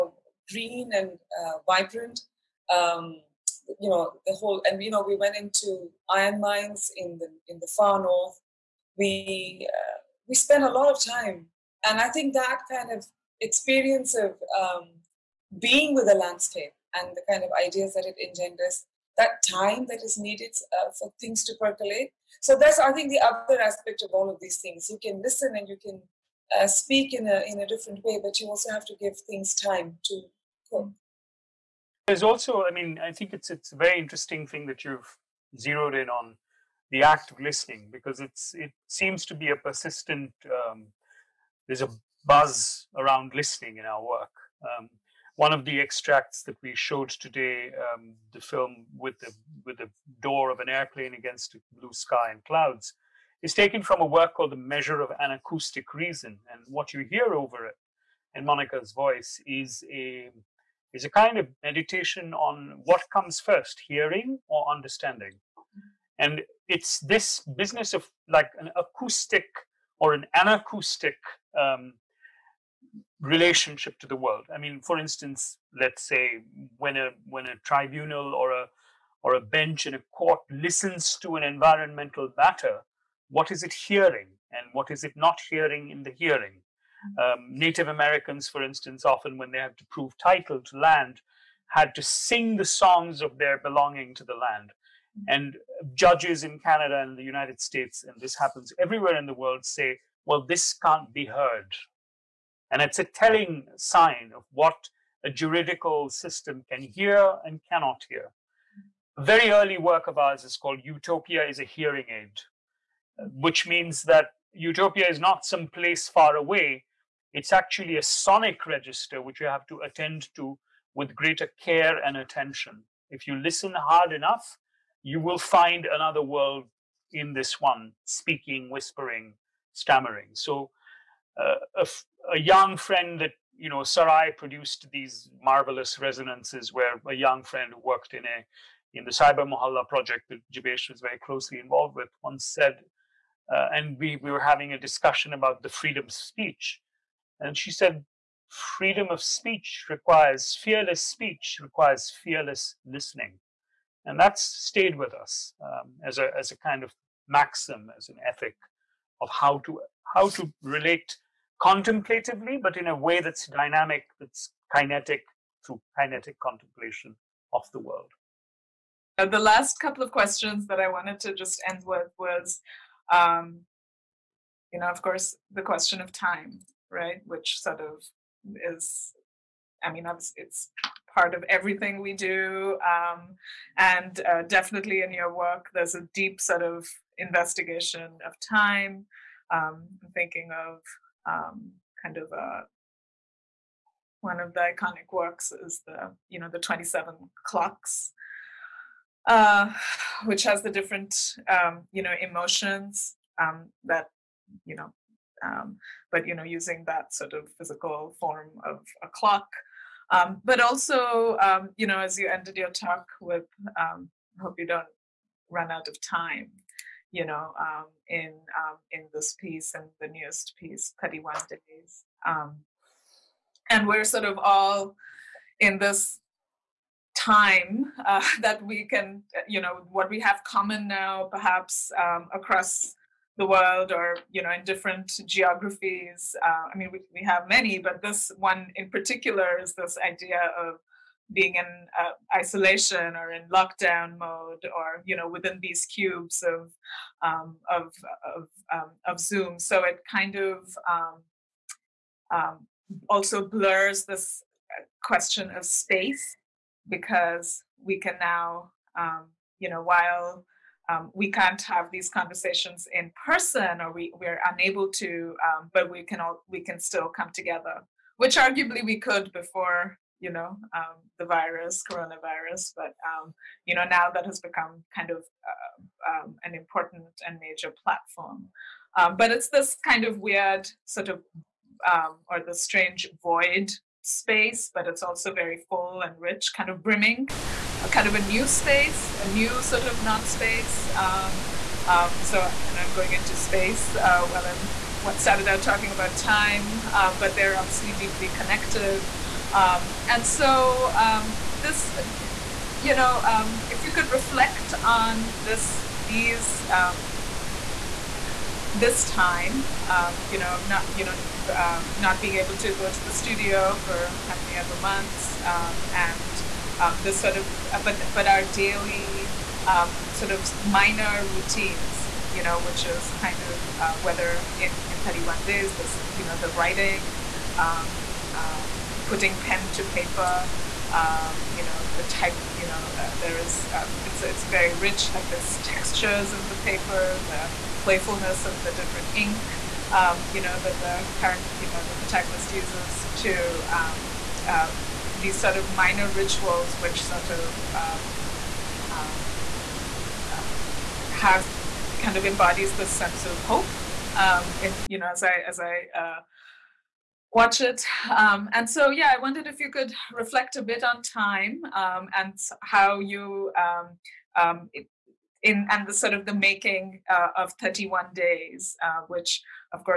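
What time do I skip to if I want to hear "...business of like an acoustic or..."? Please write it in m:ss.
1:07.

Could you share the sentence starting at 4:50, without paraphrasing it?
Um, so, and I'm going into space uh, while I'm what started out talking about time, um, but they're obviously deeply connected.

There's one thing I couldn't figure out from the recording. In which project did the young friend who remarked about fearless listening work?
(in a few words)
Cybermohalla.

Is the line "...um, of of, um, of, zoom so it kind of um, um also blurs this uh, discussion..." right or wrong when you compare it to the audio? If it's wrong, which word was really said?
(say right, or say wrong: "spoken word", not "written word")
wrong: "question", not "discussion".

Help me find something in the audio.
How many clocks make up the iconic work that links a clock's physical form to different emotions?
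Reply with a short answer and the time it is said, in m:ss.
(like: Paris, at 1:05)
27, at 3:16.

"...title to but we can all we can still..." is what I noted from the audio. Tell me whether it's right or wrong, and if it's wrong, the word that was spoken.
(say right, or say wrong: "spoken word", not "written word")
wrong: "unable", not "title".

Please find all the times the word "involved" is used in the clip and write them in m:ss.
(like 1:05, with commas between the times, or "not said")
2:21.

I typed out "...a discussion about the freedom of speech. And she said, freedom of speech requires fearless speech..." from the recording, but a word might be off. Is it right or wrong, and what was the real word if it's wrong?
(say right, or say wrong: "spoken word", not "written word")
right.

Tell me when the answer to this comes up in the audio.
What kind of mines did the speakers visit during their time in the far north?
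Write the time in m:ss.
0:06.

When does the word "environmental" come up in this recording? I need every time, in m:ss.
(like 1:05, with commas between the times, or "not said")
1:21.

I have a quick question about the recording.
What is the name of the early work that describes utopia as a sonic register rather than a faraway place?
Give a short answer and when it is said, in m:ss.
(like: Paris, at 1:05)
Utopia is a Hearing Aid, at 1:50.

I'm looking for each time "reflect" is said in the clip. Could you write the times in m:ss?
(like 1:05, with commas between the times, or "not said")
5:04, 6:00.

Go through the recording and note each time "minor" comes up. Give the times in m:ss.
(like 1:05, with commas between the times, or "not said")
5:20, 5:45.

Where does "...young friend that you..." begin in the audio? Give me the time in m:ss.
2:12.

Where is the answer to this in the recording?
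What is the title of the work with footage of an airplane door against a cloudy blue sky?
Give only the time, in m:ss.
0:54.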